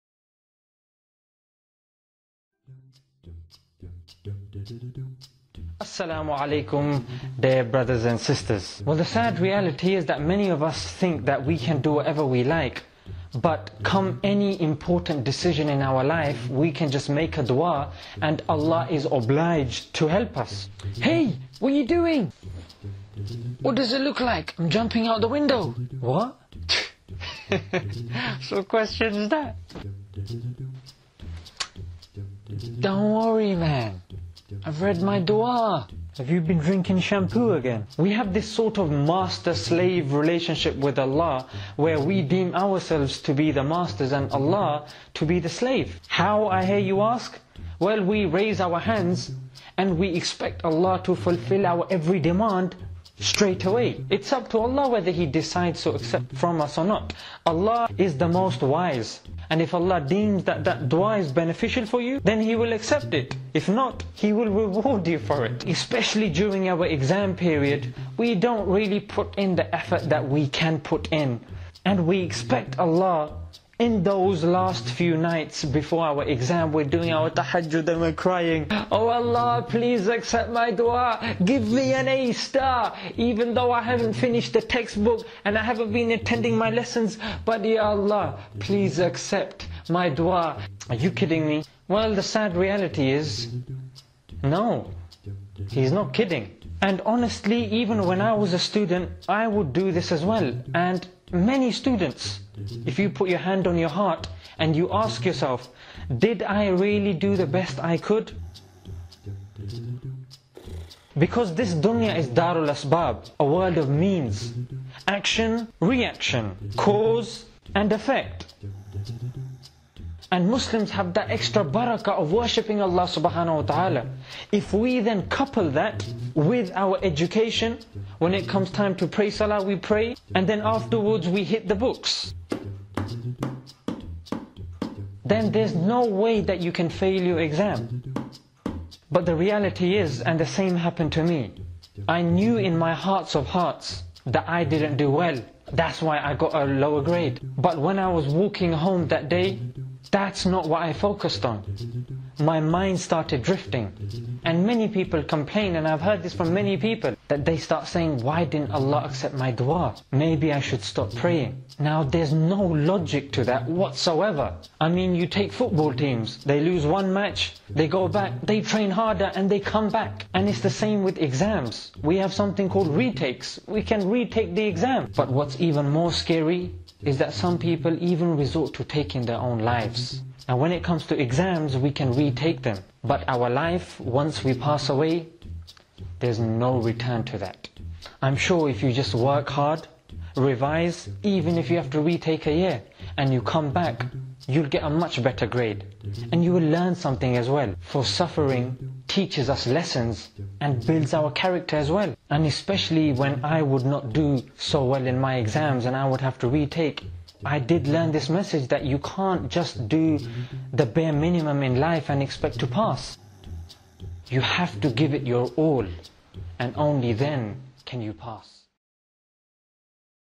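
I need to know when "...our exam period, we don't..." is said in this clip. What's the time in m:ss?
1:06.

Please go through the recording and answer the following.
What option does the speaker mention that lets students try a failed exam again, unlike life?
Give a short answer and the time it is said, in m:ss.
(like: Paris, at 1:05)
Retakes, at 2:52.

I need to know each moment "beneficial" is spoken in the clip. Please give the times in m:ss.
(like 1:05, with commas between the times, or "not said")
1:01.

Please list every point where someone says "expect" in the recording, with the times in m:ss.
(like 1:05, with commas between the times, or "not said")
0:50, 1:12, 3:32.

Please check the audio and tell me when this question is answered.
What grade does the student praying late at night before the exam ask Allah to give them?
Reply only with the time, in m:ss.
1:22.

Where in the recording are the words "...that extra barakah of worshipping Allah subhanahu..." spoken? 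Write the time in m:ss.
2:01.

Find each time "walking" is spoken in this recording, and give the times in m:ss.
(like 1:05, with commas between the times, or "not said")
2:28.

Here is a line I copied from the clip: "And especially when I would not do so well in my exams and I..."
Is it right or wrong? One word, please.
right.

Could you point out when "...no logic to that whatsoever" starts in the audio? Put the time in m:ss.
2:42.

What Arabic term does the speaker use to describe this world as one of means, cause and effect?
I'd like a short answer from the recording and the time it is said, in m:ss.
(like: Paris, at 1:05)
darul asbab, at 1:52.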